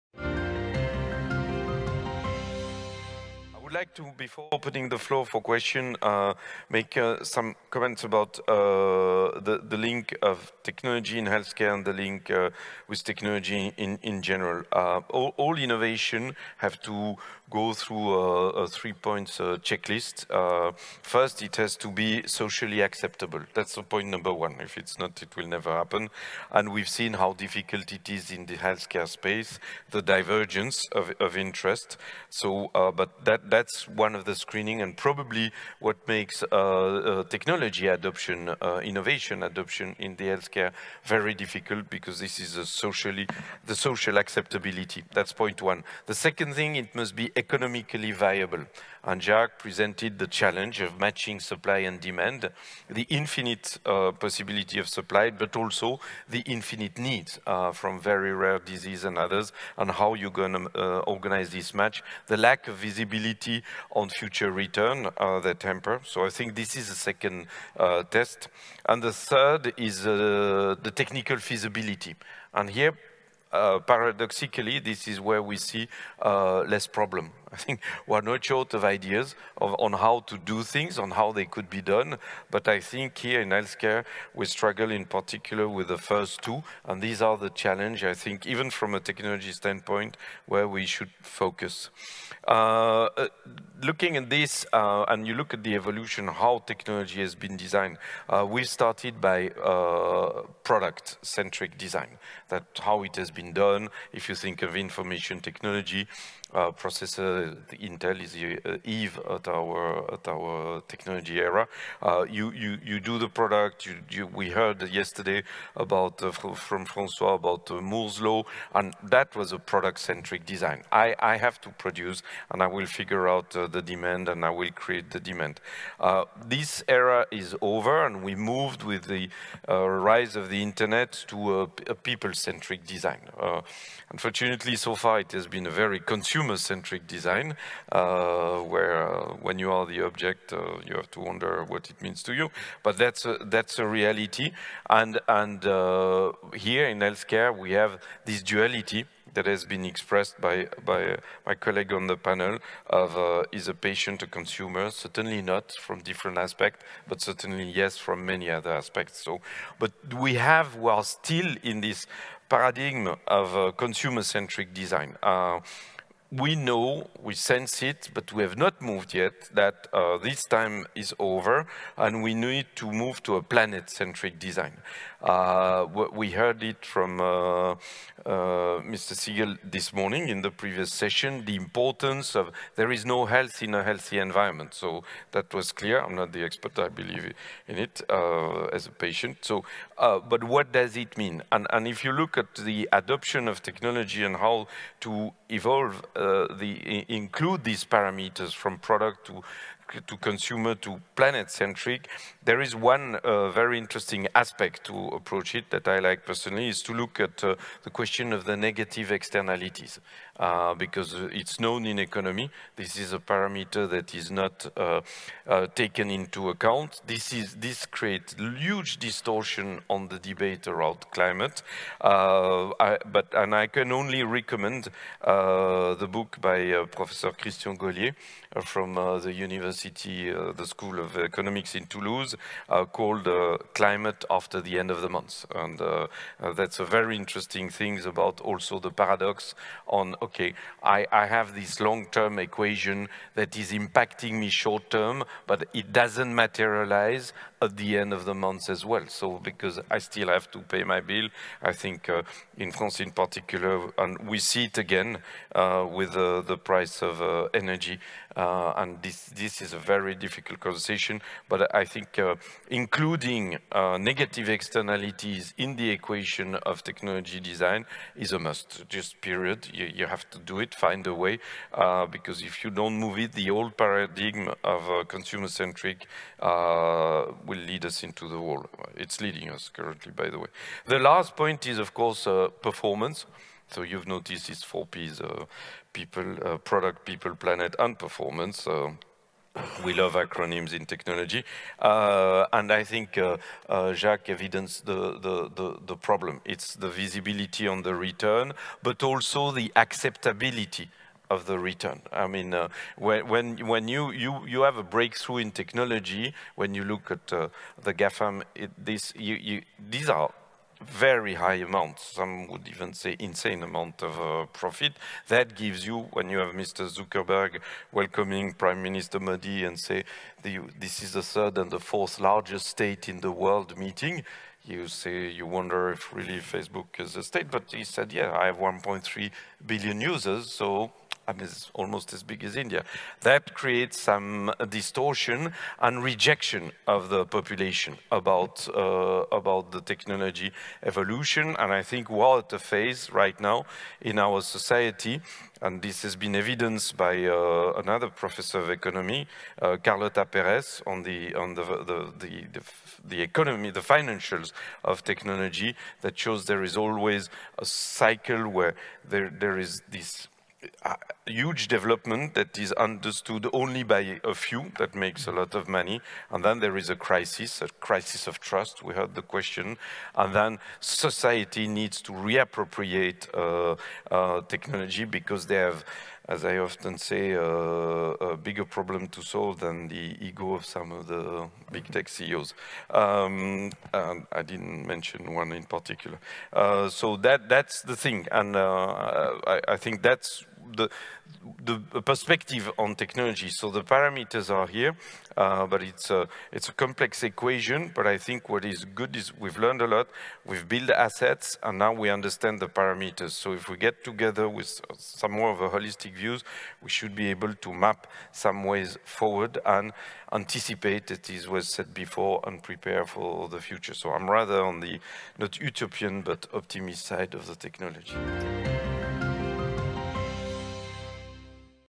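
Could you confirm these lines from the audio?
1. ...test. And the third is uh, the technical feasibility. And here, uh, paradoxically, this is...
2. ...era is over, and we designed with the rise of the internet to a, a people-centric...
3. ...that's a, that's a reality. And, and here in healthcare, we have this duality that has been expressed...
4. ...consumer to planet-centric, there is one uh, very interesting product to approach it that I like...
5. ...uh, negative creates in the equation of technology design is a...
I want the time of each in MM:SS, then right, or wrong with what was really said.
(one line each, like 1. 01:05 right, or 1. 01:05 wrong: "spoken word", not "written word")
1. 01:08 right
2. 02:06 wrong: "moved", not "designed"
3. 02:22 right
4. 03:20 wrong: "aspect", not "product"
5. 04:23 wrong: "externalities", not "creates".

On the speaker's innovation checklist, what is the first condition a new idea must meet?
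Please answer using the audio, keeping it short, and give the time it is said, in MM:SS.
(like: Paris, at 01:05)
socially acceptable, at 00:22.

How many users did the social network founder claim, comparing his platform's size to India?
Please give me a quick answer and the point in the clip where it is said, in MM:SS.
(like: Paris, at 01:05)
1.3 billion, at 05:28.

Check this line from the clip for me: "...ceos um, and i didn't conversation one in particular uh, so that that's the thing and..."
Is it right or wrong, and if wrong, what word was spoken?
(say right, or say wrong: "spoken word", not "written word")
wrong: "mention", not "conversation".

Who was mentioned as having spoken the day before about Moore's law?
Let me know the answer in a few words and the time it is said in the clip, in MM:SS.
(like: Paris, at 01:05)
Francois, at 01:56.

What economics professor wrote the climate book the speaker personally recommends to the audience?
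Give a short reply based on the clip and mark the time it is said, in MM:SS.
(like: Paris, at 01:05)
Christian Gollier, at 03:47.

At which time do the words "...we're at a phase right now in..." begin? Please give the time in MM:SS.
05:42.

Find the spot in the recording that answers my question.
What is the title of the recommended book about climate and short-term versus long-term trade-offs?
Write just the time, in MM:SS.
03:53.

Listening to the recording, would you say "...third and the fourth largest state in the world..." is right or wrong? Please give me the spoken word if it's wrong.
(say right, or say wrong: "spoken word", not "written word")
right.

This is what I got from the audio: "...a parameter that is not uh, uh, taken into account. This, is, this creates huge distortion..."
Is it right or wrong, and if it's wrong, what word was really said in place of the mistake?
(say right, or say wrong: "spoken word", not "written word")
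right.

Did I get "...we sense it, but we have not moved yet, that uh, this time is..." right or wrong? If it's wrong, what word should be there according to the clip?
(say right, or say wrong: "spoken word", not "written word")
right.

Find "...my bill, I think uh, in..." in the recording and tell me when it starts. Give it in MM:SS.
04:10.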